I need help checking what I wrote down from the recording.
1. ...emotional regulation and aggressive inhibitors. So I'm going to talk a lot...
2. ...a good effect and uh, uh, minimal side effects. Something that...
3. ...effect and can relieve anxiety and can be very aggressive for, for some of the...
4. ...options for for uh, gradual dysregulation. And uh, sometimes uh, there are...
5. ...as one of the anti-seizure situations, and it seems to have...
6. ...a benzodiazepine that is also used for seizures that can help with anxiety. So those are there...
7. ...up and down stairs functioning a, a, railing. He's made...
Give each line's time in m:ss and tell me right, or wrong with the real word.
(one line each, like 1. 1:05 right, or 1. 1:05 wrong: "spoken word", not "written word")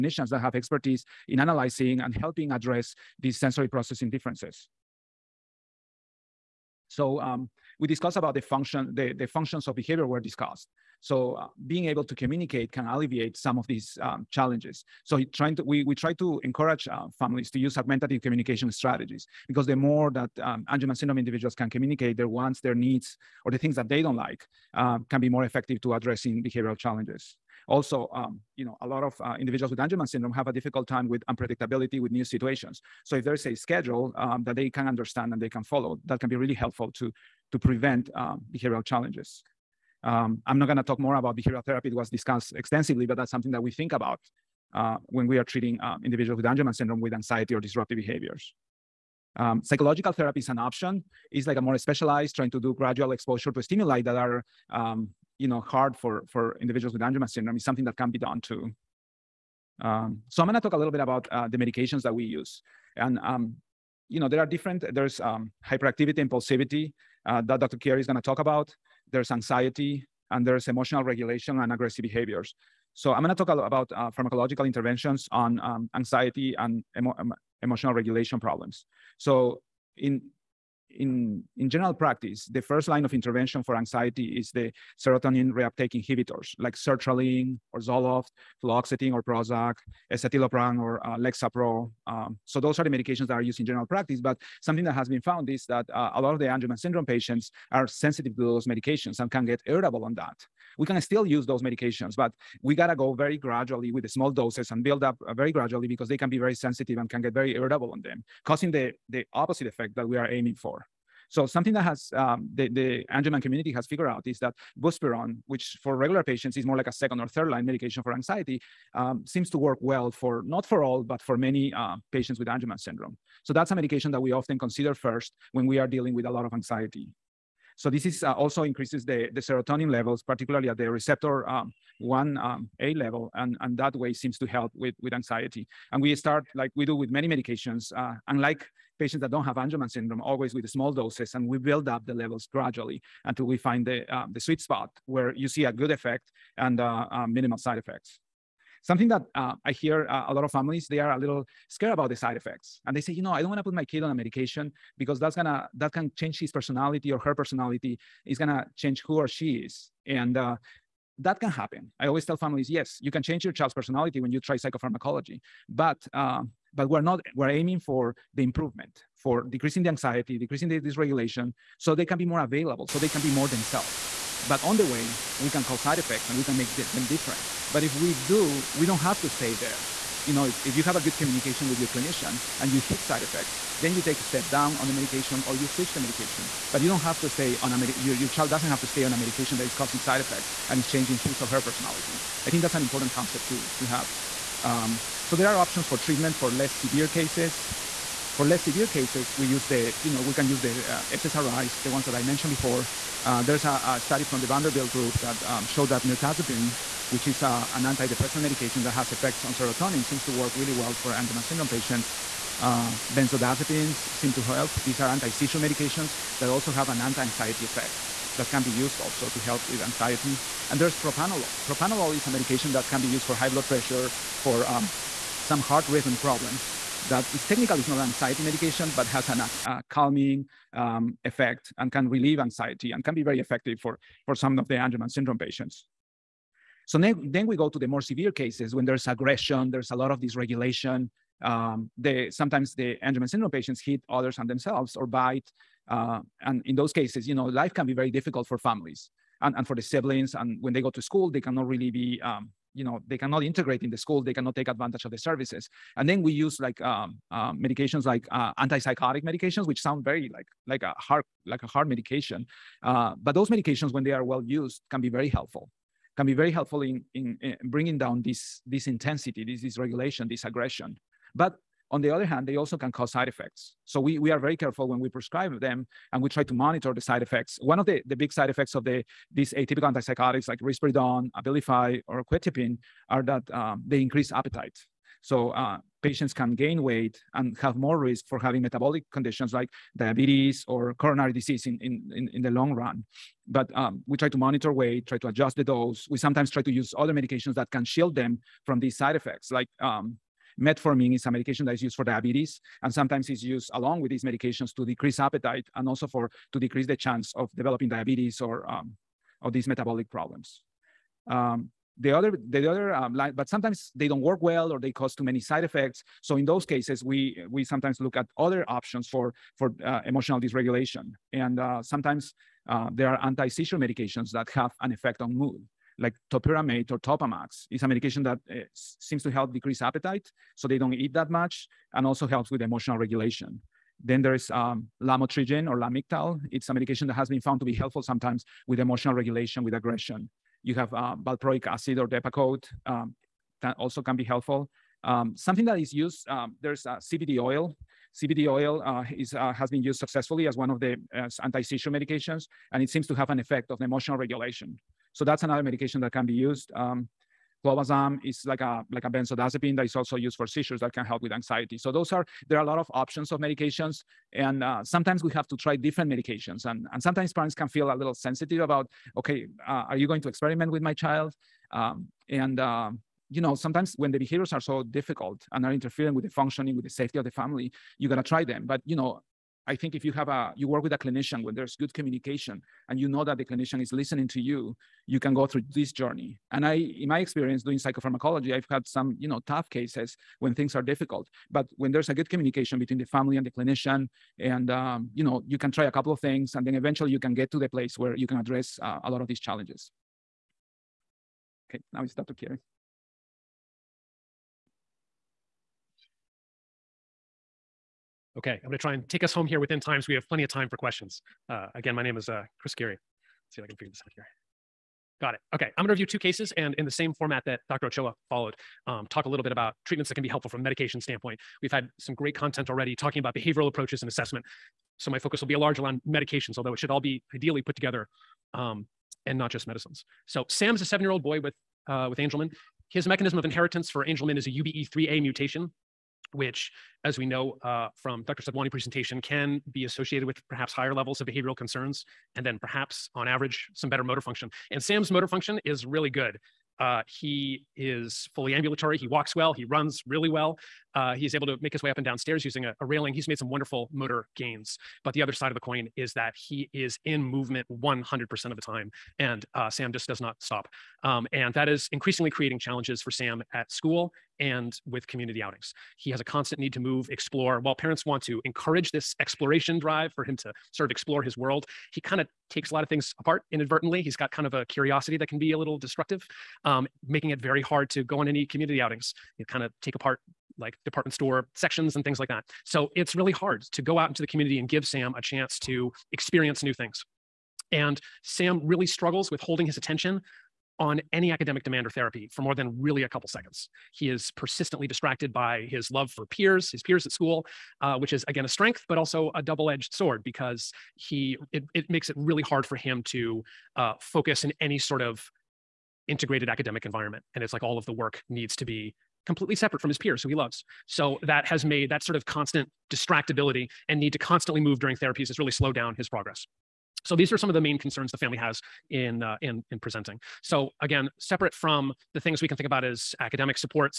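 1. 1:10 wrong: "behaviors", not "inhibitors"
2. 2:25 right
3. 3:51 wrong: "effective", not "aggressive"
4. 5:18 wrong: "emotional", not "gradual"
5. 5:50 wrong: "medications", not "situations"
6. 5:59 right
7. 7:31 wrong: "using", not "functioning".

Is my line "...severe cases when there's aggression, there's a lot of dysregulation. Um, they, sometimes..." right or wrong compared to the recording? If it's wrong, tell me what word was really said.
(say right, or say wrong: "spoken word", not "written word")
right.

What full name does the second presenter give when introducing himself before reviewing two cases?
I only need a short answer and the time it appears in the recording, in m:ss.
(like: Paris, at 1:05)
Chris Keary, at 6:52.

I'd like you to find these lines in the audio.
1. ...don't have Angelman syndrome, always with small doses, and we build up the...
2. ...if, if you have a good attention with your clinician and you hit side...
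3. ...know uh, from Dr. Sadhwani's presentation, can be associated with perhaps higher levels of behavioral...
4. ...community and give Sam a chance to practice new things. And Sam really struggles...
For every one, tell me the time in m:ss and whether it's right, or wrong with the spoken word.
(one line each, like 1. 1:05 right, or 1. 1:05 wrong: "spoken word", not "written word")
1. 2:19 right
2. 3:00 wrong: "communication", not "attention"
3. 7:17 right
4. 8:04 wrong: "experience", not "practice".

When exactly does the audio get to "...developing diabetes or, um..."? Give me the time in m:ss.
5:07.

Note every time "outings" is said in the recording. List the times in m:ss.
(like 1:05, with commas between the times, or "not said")
7:45, 7:58.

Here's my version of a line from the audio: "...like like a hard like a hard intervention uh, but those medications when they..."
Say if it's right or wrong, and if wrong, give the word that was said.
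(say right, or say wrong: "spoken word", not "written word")
wrong: "medication", not "intervention".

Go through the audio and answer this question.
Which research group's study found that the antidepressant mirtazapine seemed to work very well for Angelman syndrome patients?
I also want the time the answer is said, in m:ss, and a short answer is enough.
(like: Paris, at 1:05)
Vanderbilt, at 3:24.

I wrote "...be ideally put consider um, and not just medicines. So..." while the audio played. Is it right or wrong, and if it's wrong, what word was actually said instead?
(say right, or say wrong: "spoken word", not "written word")
wrong: "together", not "consider".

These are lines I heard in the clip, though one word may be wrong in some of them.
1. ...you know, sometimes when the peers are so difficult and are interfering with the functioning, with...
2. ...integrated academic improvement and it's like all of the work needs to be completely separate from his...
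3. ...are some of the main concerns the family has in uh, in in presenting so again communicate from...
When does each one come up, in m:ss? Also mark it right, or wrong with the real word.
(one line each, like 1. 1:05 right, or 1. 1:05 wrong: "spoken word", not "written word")
1. 6:13 wrong: "behaviors", not "peers"
2. 8:26 wrong: "environment", not "improvement"
3. 8:37 wrong: "separate", not "communicate".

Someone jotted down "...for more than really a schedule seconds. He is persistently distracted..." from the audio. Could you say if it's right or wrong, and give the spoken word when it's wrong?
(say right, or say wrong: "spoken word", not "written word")
wrong: "couple", not "schedule".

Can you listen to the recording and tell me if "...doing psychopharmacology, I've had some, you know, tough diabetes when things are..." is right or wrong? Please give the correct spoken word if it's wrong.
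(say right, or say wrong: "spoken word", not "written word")
wrong: "cases", not "diabetes".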